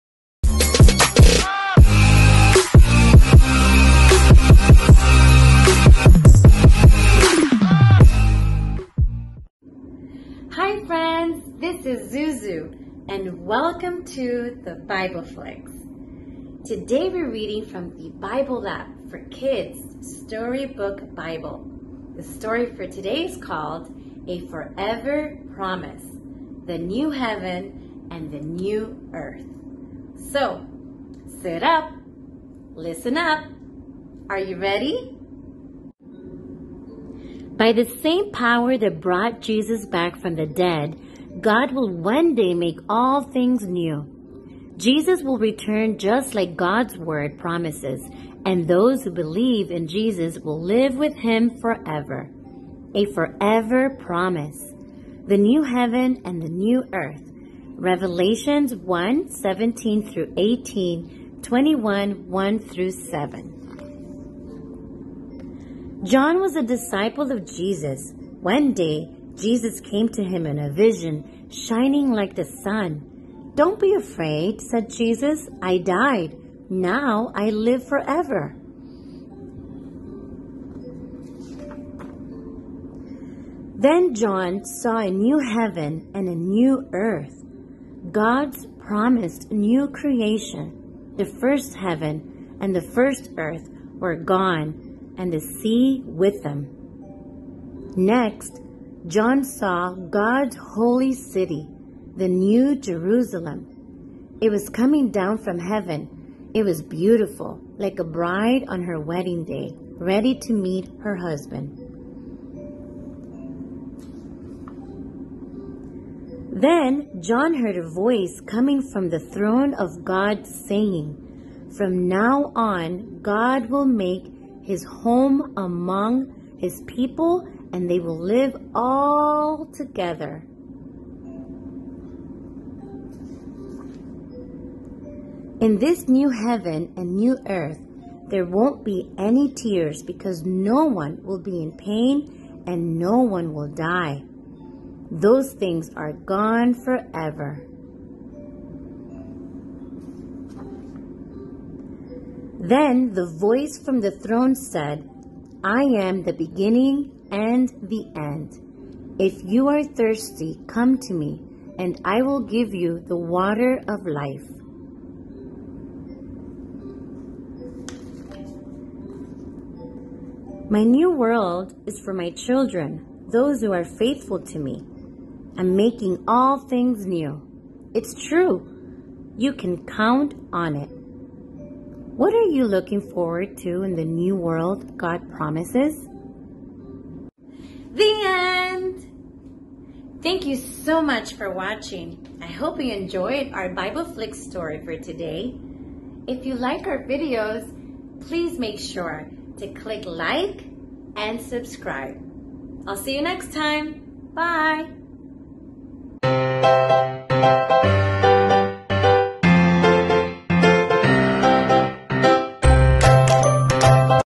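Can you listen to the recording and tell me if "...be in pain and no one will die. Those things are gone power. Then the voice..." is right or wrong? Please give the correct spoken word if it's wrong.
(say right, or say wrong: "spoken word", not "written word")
wrong: "forever", not "power".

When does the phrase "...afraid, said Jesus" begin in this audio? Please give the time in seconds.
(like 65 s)
73 s.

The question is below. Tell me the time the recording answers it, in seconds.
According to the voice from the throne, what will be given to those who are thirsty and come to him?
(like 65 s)
162 s.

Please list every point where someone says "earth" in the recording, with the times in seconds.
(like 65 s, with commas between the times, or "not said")
29 s, 56 s, 86 s, 93 s, 137 s.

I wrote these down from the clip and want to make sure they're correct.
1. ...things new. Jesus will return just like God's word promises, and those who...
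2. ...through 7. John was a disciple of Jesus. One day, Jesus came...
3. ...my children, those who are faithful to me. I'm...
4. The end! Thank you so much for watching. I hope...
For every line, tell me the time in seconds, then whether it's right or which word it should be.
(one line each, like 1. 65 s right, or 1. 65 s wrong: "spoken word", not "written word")
1. 43 s right
2. 62 s right
3. 172 s right
4. 187 s right.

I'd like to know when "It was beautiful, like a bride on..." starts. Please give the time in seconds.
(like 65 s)
106 s.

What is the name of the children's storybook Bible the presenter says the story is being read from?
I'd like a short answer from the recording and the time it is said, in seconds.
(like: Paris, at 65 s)
Bible App for Kids Storybook Bible, at 18 s.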